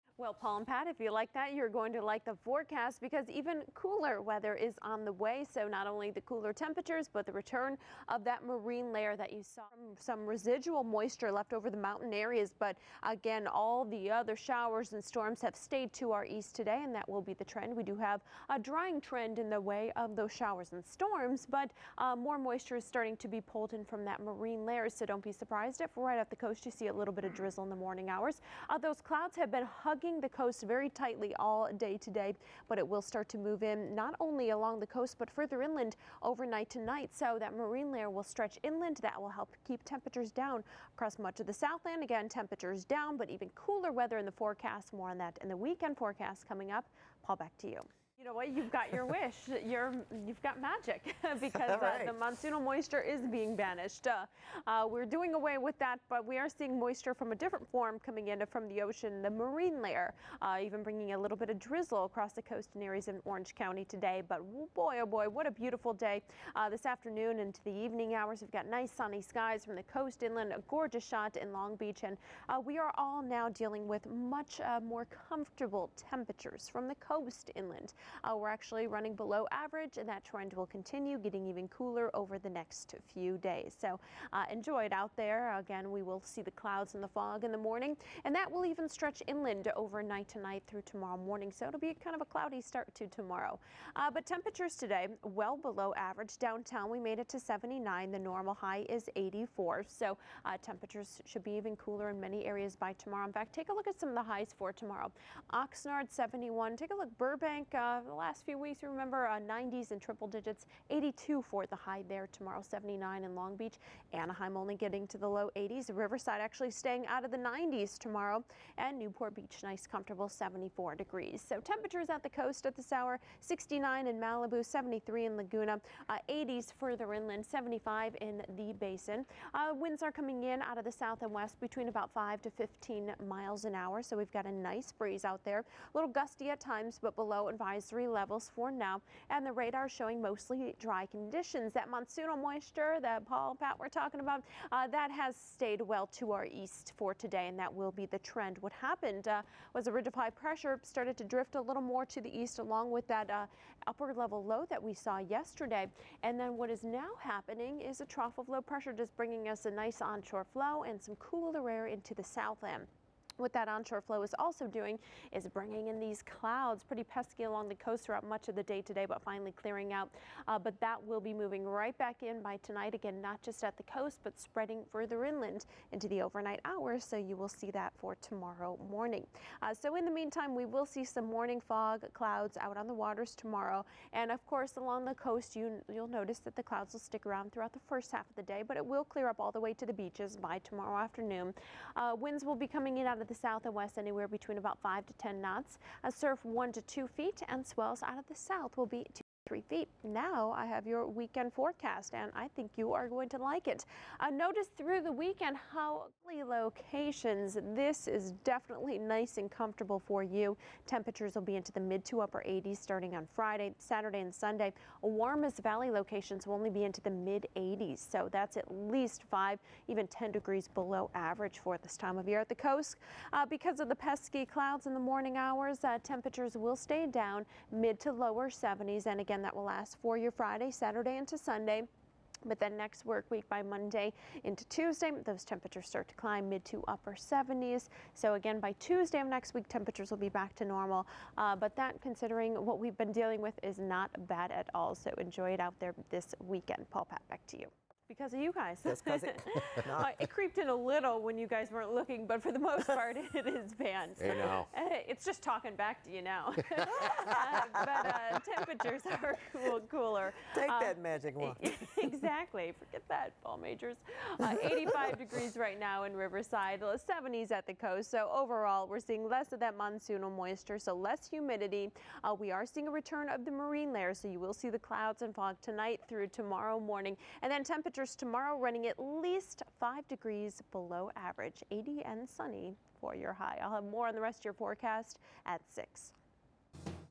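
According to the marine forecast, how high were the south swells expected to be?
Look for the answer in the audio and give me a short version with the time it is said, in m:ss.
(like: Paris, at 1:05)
3 feet, at 3:19.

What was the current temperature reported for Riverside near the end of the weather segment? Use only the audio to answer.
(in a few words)
85 degrees.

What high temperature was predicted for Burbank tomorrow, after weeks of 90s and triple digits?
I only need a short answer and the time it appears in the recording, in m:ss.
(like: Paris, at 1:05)
82, at 1:50.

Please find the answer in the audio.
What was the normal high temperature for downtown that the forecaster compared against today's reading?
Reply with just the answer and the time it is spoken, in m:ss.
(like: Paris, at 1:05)
84, at 1:38.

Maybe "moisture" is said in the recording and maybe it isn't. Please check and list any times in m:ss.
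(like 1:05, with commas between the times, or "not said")
0:10, 0:22, 0:52, 0:56, 2:22, 4:30.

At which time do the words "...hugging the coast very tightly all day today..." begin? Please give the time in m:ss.
0:30.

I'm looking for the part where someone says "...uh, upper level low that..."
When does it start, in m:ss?
2:33.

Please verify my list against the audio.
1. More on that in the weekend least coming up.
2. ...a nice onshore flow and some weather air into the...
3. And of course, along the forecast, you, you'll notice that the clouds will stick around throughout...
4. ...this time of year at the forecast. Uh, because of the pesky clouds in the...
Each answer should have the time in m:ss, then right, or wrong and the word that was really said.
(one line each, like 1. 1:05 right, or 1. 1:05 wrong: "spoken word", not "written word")
1. 0:44 wrong: "forecast", not "least"
2. 2:39 wrong: "cooler", not "weather"
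3. 3:04 wrong: "coast", not "forecast"
4. 3:41 wrong: "coast", not "forecast".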